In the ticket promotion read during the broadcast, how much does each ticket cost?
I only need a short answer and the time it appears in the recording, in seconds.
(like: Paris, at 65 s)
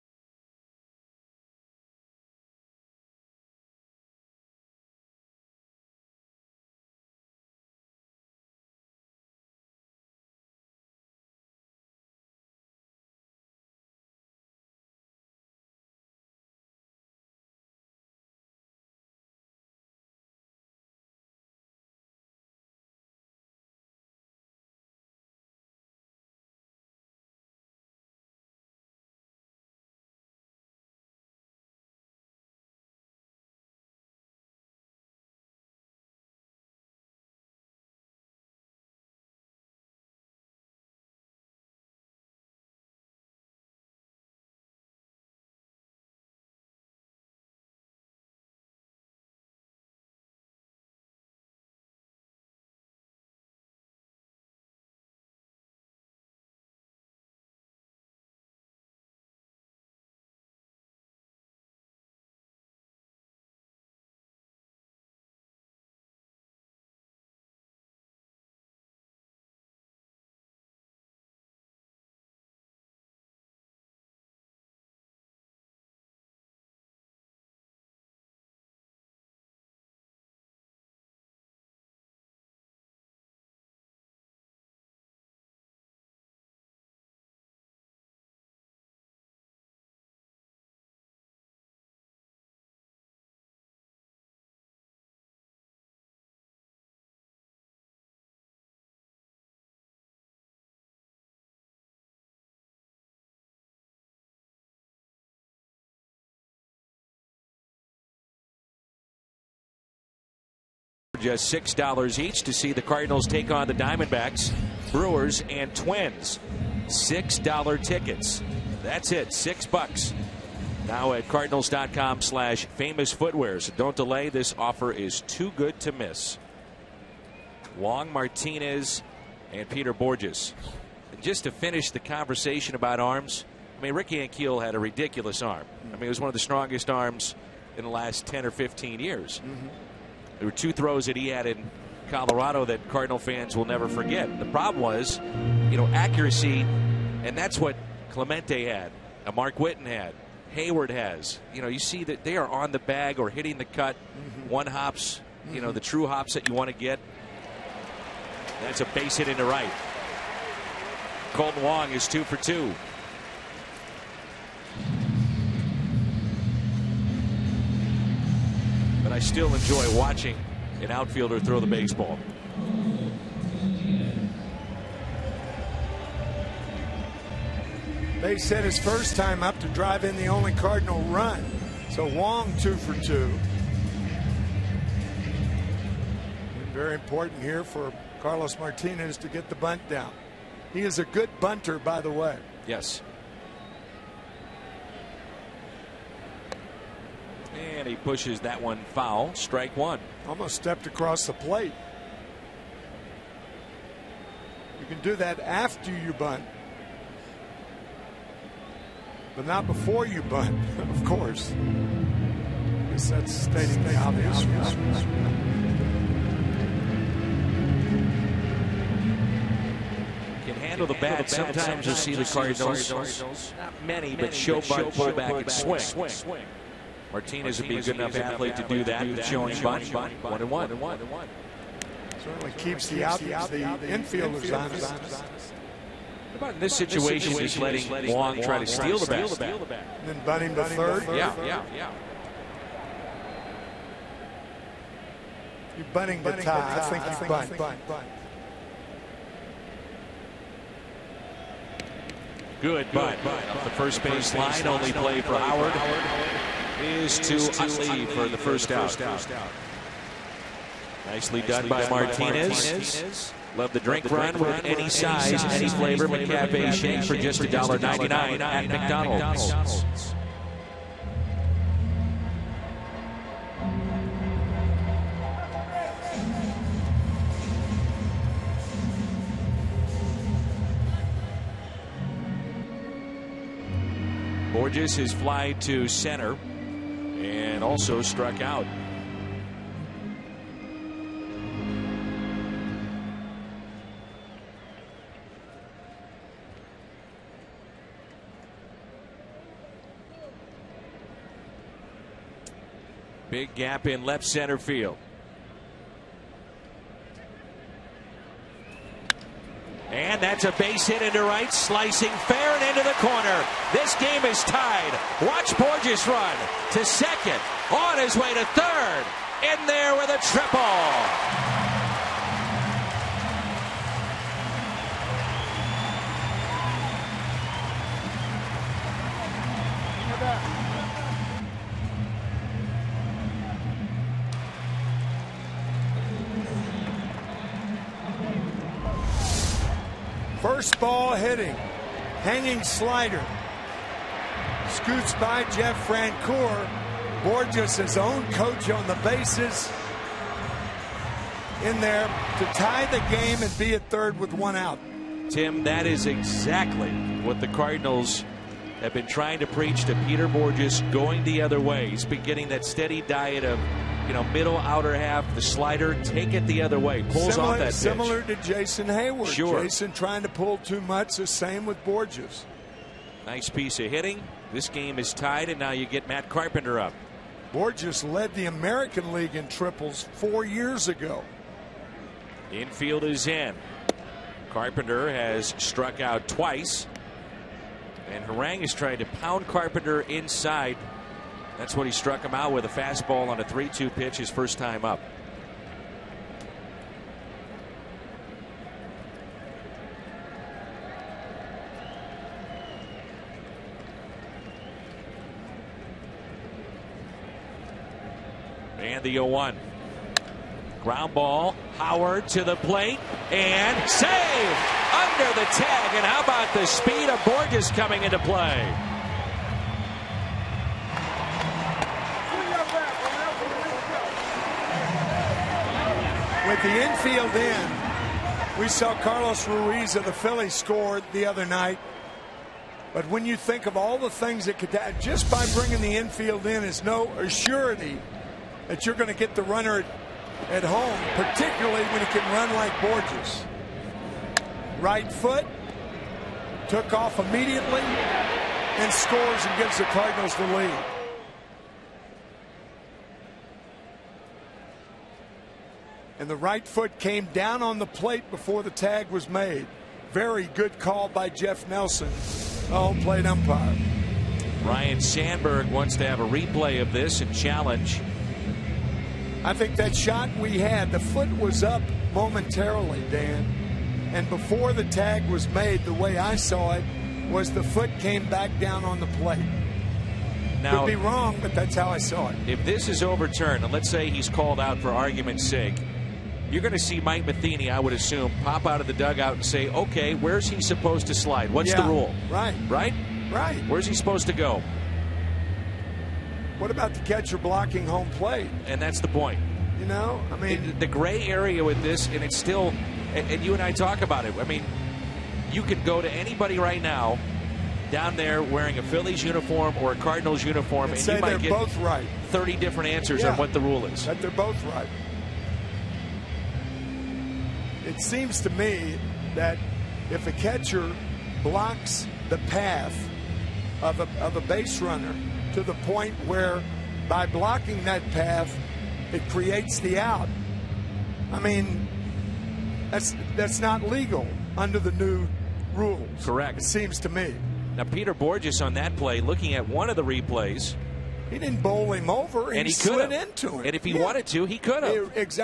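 $6, at 111 s.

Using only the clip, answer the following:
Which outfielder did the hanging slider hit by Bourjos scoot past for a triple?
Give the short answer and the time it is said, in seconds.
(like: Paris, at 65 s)
Jeff Francoeur, at 345 s.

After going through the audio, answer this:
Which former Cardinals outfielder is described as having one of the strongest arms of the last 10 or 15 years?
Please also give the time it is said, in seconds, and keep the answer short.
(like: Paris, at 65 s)
Ricky Ankiel, at 133 s.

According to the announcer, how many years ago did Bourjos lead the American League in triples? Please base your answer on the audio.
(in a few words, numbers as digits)
4.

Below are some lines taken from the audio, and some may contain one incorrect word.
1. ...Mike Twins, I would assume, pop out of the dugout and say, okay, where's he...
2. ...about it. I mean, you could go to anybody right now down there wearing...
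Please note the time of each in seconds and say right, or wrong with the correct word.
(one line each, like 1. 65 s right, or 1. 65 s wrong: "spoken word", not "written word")
1. 486 s wrong: "Matheny", not "Twins"
2. 504 s right.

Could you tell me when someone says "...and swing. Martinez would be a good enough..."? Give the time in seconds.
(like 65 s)
225 s.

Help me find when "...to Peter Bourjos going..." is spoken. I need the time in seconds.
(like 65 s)
359 s.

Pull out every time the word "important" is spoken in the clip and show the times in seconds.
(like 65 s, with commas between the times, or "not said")
186 s.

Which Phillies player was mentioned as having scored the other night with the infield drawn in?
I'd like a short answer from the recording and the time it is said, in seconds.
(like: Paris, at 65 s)
Carlos Ruiz, at 429 s.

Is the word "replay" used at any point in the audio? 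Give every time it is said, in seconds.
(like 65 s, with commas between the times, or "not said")
466 s, 540 s.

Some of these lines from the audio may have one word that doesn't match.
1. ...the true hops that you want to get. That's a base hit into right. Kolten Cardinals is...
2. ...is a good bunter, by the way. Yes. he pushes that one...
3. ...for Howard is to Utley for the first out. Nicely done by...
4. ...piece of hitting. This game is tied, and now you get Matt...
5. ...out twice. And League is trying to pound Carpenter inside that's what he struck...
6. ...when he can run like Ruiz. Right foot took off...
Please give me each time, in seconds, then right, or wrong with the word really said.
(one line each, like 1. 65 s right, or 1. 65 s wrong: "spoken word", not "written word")
1. 155 s wrong: "Wong", not "Cardinals"
2. 190 s right
3. 255 s right
4. 373 s right
5. 385 s wrong: "Harang", not "League"
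6. 441 s wrong: "Bourjos", not "Ruiz".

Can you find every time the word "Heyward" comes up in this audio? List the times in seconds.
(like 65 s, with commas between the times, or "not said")
150 s, 368 s.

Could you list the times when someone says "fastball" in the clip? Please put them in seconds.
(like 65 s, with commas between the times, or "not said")
392 s.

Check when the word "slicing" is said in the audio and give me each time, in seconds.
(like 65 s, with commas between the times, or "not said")
311 s.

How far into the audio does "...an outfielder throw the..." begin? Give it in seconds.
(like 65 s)
170 s.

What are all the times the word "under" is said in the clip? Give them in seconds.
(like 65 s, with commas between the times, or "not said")
414 s, 534 s.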